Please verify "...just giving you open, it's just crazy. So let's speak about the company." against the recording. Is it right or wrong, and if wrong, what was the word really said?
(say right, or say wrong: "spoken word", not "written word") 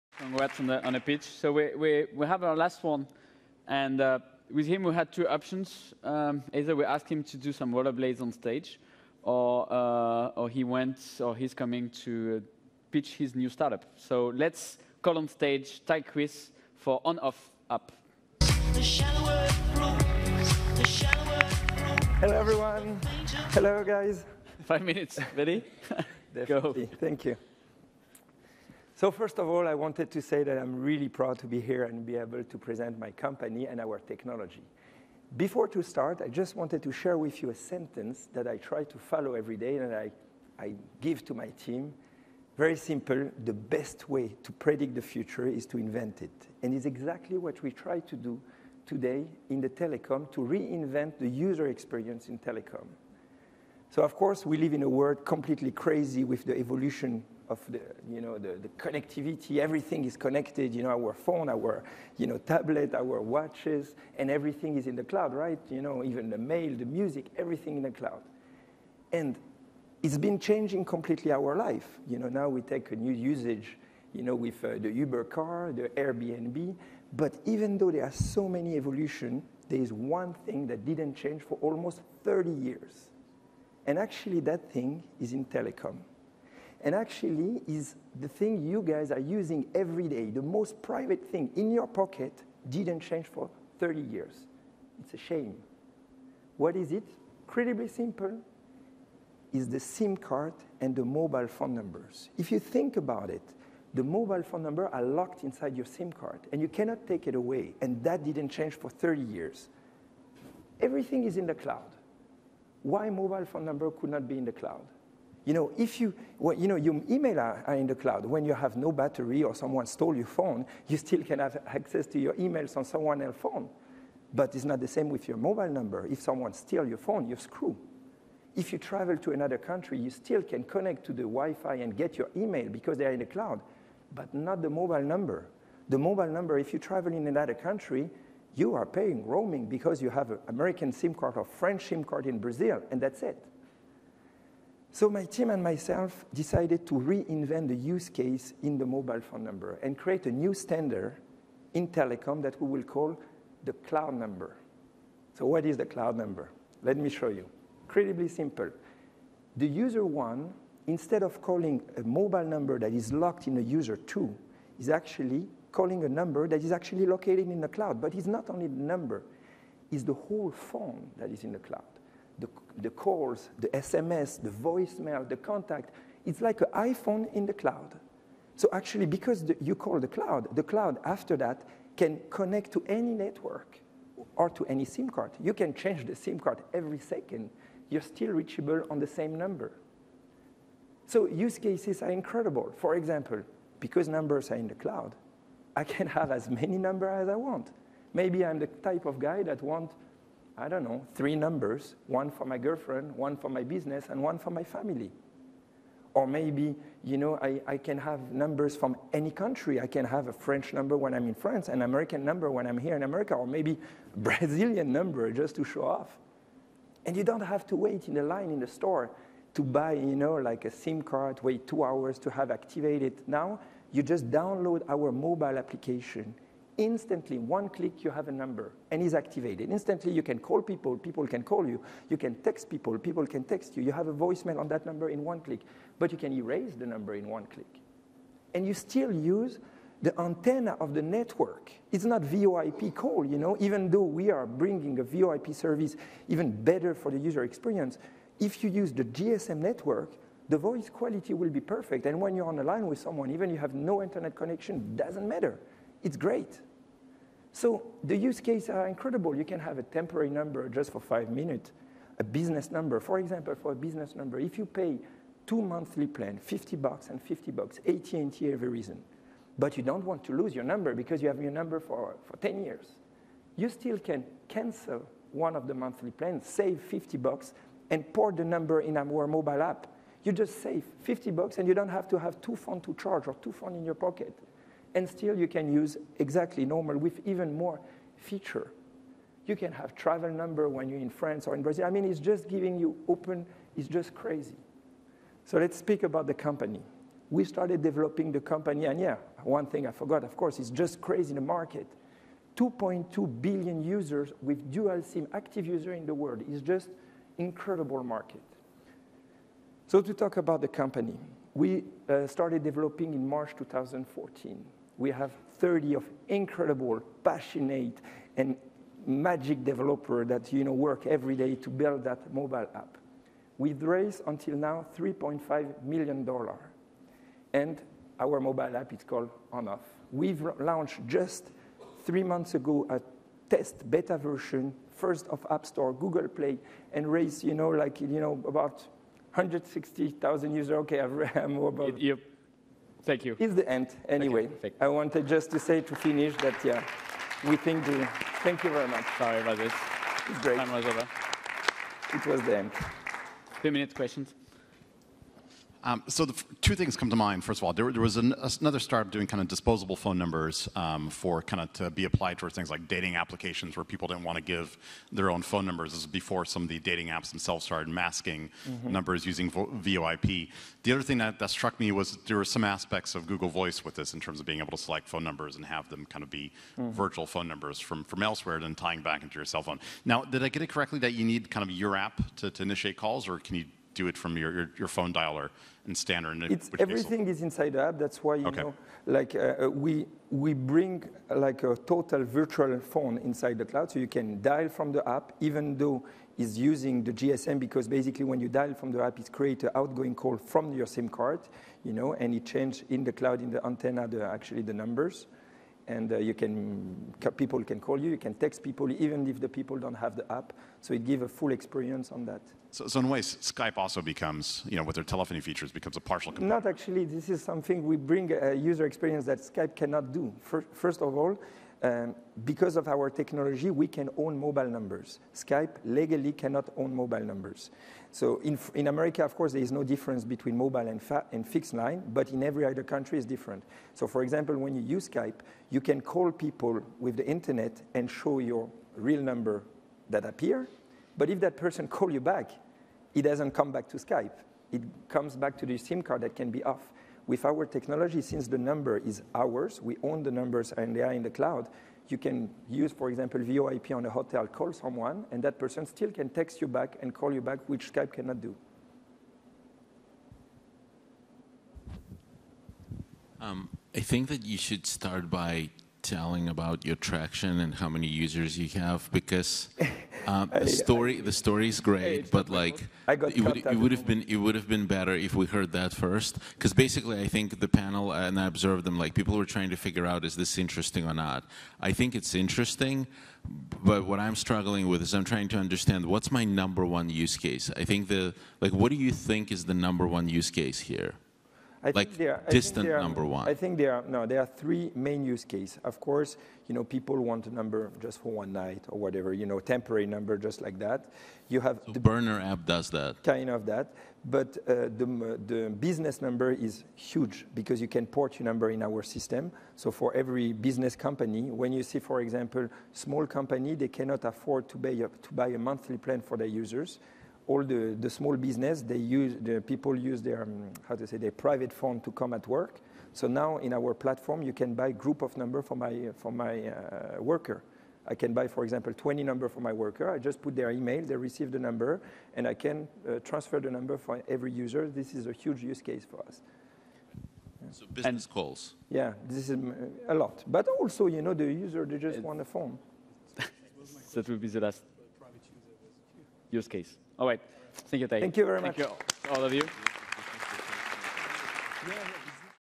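right.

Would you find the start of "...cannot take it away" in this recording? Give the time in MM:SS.
01:46.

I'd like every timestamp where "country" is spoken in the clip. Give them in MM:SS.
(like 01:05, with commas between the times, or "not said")
02:09, 02:17, 03:29, 07:12.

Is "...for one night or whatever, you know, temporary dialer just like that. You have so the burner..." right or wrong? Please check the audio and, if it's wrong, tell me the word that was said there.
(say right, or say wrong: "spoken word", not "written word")
wrong: "number", not "dialer".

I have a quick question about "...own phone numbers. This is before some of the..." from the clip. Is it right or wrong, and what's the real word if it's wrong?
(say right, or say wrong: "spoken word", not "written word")
right.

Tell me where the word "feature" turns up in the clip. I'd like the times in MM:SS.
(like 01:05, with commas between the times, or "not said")
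04:48, 06:55.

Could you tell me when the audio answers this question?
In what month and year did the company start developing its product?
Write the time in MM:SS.
05:13.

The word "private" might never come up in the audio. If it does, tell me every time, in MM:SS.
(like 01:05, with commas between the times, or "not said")
01:30, 08:41.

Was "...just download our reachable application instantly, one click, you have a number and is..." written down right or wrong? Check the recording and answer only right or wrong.
wrong.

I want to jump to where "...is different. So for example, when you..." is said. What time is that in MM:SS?
07:13.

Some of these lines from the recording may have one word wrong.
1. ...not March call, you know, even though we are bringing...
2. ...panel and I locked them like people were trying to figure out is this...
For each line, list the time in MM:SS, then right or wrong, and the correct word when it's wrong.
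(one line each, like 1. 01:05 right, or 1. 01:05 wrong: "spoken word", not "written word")
1. 04:02 wrong: "VoIP", not "March"
2. 07:57 wrong: "observed", not "locked".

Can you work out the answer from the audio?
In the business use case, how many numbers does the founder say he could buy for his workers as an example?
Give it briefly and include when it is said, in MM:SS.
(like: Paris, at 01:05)
20, at 08:48.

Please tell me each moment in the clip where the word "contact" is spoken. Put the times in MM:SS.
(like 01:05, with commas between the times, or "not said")
02:55.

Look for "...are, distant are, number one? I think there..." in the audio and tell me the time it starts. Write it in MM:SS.
08:12.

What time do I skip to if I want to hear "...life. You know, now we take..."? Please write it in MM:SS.
01:11.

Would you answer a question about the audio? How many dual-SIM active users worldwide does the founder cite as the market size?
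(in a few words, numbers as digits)
2.2 billion.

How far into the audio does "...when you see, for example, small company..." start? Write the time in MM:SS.
08:31.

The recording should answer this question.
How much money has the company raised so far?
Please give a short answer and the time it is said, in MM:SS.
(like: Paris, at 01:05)
$3.5 million, at 05:24.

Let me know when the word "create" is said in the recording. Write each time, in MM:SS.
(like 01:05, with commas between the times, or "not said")
02:29, 06:39.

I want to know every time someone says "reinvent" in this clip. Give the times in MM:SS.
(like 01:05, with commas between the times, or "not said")
00:50, 02:26.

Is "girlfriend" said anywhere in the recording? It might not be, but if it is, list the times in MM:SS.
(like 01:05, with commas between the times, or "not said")
03:22.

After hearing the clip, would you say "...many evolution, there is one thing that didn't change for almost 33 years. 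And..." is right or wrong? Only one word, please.
wrong.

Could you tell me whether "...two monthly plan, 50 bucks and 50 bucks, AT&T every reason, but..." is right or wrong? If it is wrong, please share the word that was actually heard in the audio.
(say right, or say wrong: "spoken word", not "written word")
right.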